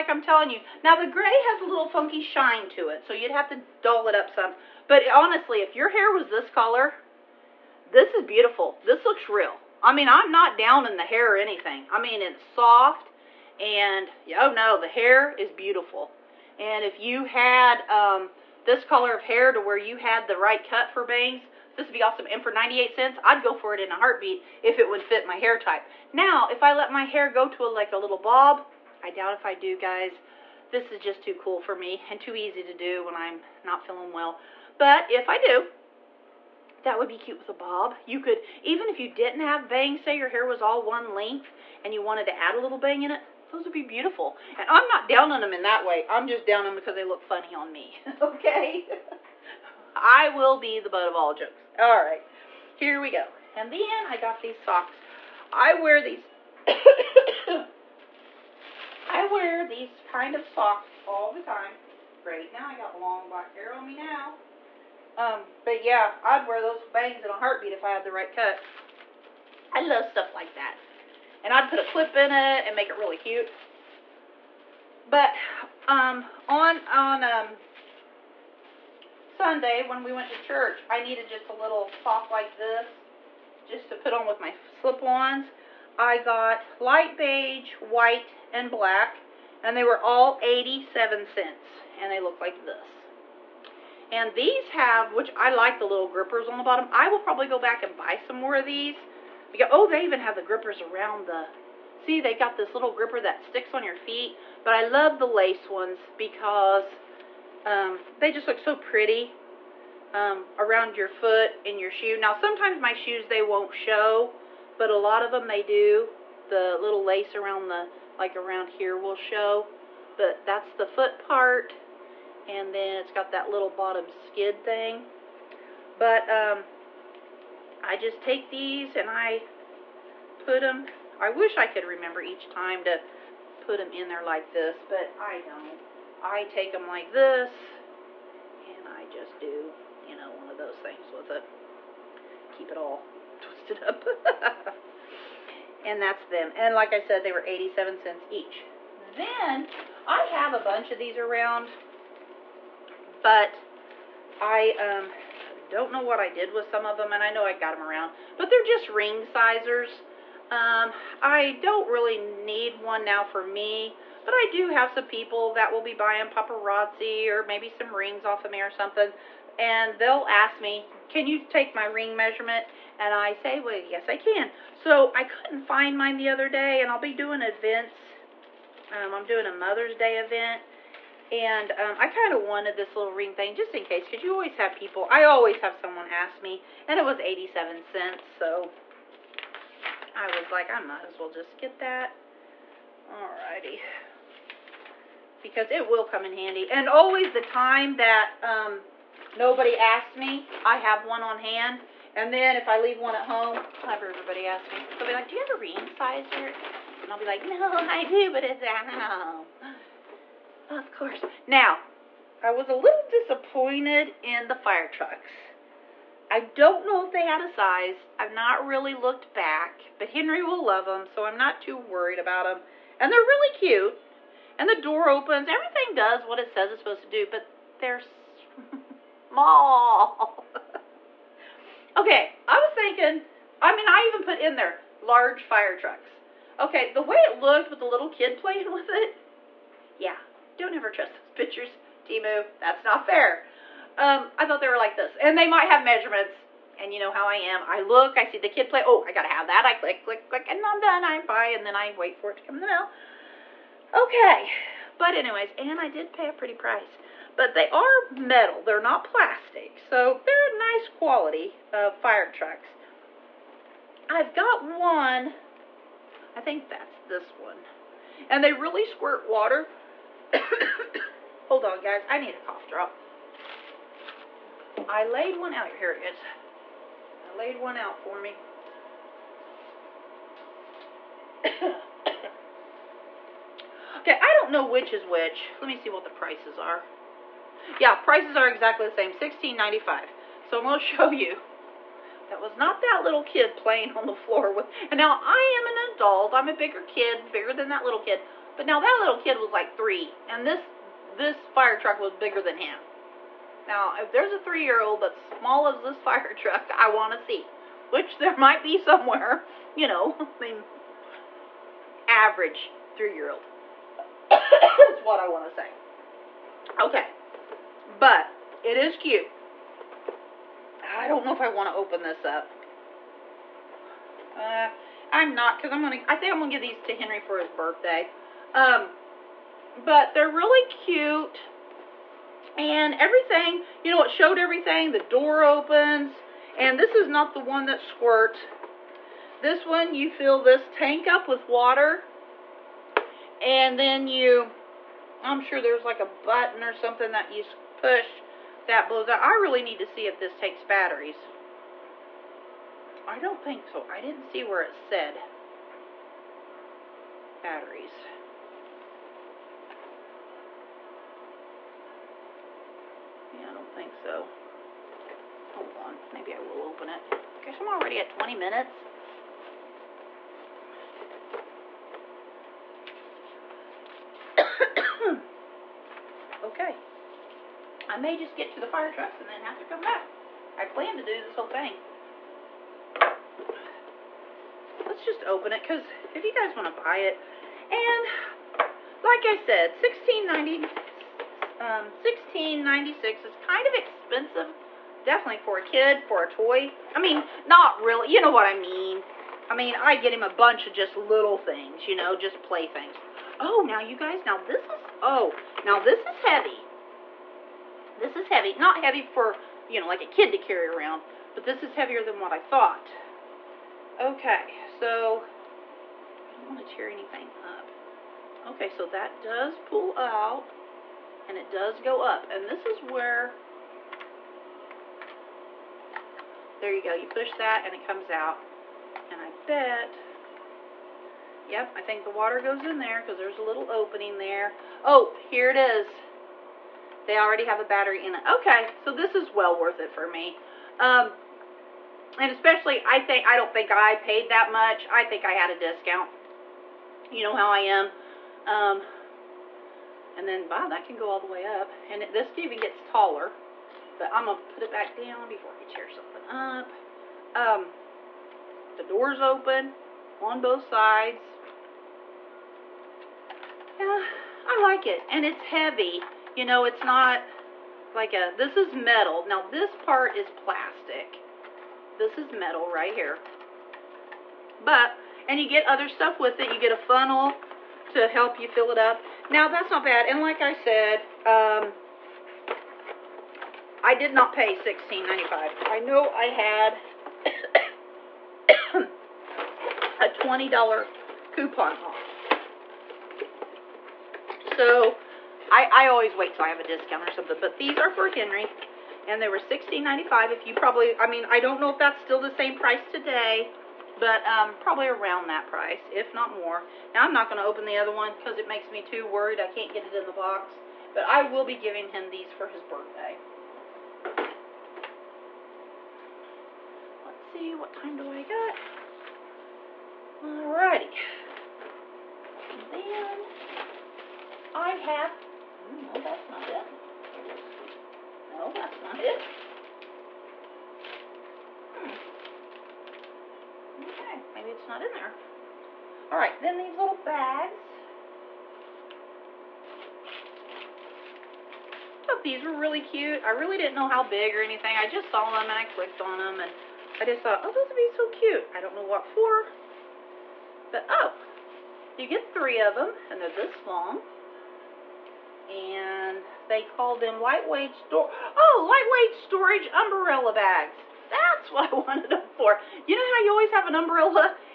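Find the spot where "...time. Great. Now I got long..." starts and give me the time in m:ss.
1:01.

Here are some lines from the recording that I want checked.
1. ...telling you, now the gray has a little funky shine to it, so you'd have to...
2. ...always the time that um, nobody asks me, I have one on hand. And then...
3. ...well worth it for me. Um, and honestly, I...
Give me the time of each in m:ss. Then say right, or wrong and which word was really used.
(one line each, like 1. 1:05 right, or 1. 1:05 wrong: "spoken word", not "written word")
1. 0:00 right
2. 3:16 right
3. 7:19 wrong: "especially", not "honestly".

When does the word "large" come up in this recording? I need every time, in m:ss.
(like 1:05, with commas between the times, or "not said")
3:54.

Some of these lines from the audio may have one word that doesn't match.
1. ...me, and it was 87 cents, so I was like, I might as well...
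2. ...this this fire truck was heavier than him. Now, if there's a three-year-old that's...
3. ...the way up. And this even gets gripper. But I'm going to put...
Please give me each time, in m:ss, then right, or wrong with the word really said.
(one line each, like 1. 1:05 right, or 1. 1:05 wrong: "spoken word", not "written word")
1. 3:06 right
2. 5:00 wrong: "bigger", not "heavier"
3. 7:31 wrong: "taller", not "gripper".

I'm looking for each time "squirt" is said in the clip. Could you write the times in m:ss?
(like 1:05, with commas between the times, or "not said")
4:28, 5:37.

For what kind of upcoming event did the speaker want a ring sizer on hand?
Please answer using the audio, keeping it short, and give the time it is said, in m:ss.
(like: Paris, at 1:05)
Mother's Day event, at 2:59.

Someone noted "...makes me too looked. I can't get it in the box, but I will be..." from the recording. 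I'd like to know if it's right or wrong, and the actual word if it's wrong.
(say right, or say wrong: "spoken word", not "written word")
wrong: "worried", not "looked".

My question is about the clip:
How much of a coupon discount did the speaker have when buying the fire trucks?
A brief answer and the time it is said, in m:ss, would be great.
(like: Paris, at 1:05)
$20, at 8:10.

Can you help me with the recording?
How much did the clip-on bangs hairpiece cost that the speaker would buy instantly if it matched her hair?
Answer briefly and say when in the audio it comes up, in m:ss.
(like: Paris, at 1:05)
98 cents, at 0:22.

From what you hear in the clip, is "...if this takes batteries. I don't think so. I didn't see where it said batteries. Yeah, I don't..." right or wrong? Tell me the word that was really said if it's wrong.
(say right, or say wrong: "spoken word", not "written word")
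right.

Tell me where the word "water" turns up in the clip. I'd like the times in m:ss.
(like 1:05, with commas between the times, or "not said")
4:29, 5:41, 7:12.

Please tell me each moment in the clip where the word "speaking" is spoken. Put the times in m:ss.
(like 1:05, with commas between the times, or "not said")
not said.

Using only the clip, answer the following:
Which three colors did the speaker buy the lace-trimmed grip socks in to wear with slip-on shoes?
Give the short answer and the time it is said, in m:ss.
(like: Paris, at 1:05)
Light beige, white, and black, at 1:26.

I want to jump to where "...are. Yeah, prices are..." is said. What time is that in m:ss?
4:46.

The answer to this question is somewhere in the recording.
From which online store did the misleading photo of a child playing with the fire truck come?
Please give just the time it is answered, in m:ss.
4:02.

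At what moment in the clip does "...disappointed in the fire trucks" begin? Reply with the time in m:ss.
3:33.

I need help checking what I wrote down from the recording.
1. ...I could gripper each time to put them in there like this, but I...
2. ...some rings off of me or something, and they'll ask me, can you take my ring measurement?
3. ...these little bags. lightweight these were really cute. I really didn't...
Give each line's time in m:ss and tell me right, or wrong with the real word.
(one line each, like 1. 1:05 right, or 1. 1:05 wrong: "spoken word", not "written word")
1. 2:11 wrong: "remember", not "gripper"
2. 2:47 right
3. 8:56 wrong: "thought", not "lightweight".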